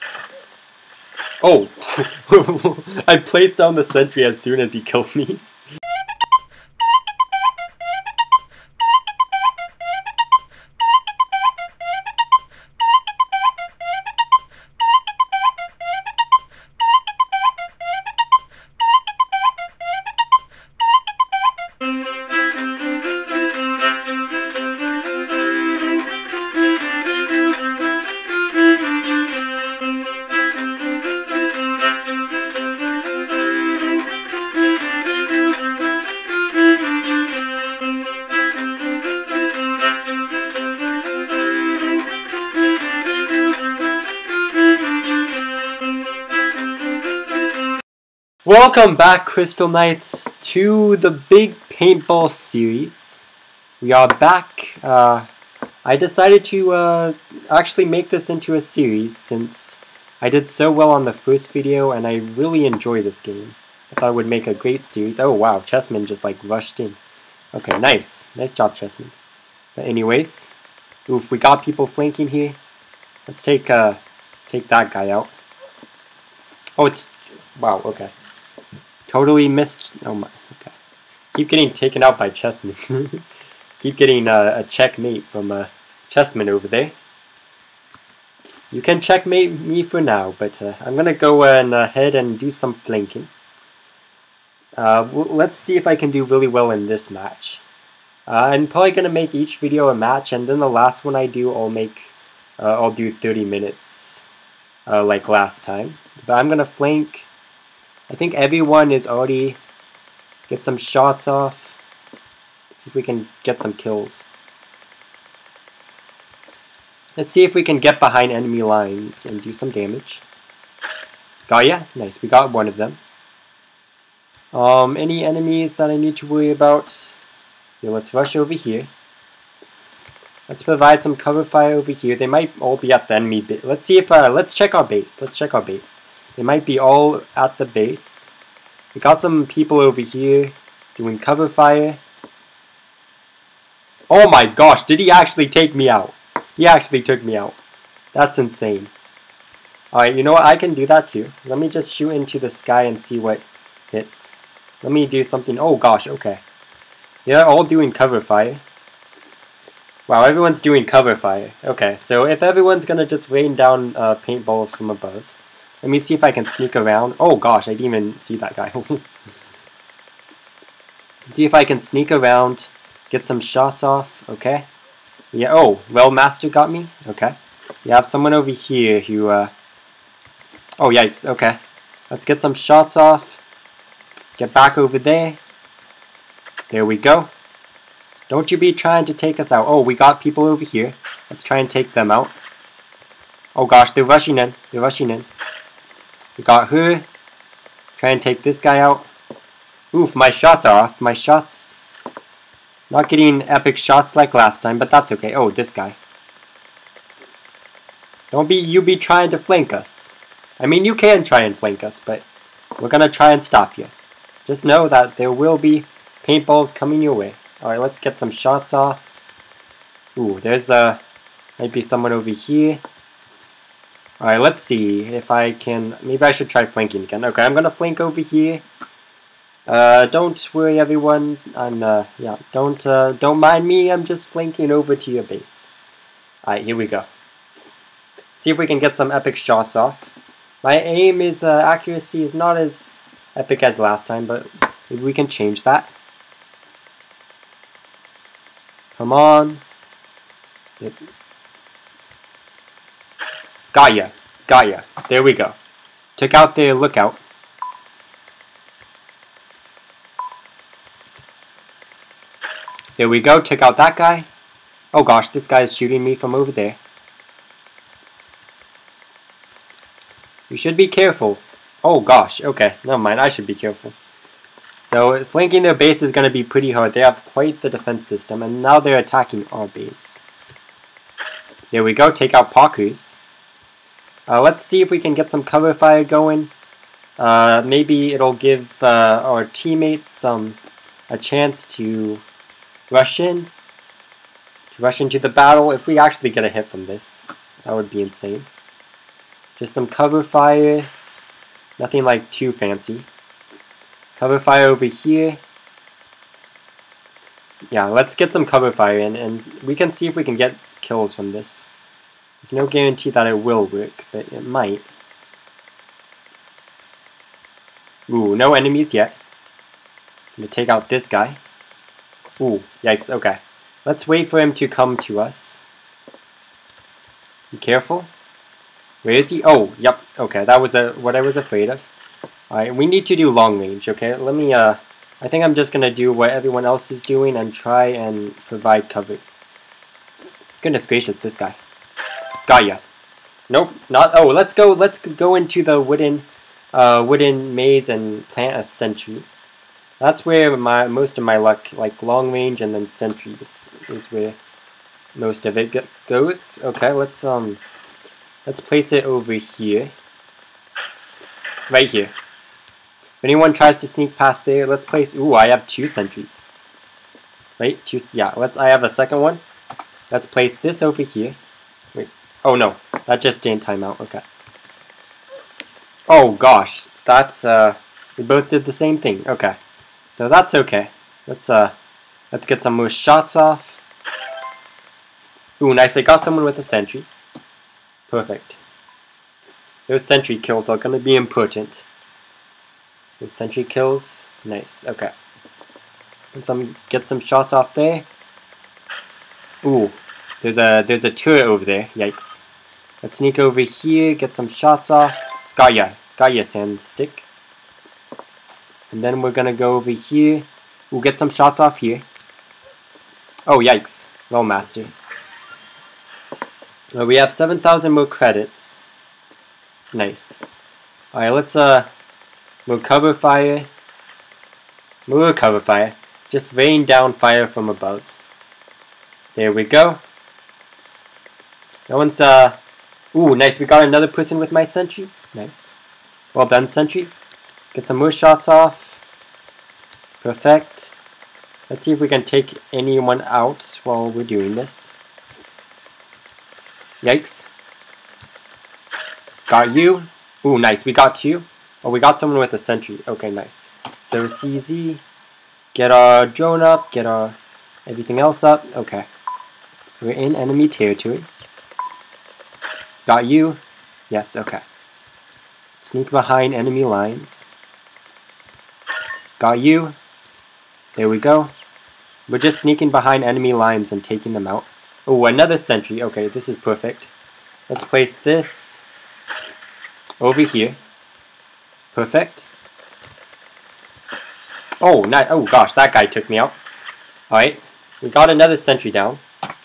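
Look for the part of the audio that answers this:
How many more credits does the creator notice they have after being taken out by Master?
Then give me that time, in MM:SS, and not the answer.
06:57.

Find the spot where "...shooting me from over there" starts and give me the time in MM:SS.
04:25.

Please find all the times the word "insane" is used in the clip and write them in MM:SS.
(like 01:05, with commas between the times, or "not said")
02:28, 04:58.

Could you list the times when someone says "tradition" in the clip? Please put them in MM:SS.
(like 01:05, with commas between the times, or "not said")
not said.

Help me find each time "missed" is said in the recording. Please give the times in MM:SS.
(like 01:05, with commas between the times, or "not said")
01:19.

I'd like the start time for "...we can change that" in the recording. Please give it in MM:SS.
04:05.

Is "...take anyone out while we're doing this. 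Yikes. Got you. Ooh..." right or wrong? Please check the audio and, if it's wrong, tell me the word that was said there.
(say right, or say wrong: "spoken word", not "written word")
right.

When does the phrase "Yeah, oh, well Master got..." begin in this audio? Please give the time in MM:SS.
02:55.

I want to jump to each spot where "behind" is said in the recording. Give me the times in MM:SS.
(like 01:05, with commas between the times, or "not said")
01:57, 07:46, 07:52.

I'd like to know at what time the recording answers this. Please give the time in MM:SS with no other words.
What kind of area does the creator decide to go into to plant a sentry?
05:45.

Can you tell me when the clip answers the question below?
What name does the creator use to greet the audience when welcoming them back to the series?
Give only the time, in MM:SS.
00:49.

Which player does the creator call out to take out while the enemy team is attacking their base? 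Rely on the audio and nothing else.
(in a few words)
Pakus.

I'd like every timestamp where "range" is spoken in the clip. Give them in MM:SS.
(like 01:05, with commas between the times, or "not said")
05:33, 05:52.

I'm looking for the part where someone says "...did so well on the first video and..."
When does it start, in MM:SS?
01:00.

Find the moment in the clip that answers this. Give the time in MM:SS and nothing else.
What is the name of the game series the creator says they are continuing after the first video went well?
00:51.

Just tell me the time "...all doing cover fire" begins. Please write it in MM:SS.
02:37.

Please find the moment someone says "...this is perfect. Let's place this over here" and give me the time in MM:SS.
07:56.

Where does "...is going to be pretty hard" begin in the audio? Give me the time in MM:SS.
04:36.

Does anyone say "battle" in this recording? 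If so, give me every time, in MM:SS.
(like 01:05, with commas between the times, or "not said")
04:55.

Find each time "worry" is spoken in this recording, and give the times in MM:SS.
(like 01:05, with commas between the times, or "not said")
02:06, 03:50.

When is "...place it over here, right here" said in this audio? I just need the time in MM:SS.
05:58.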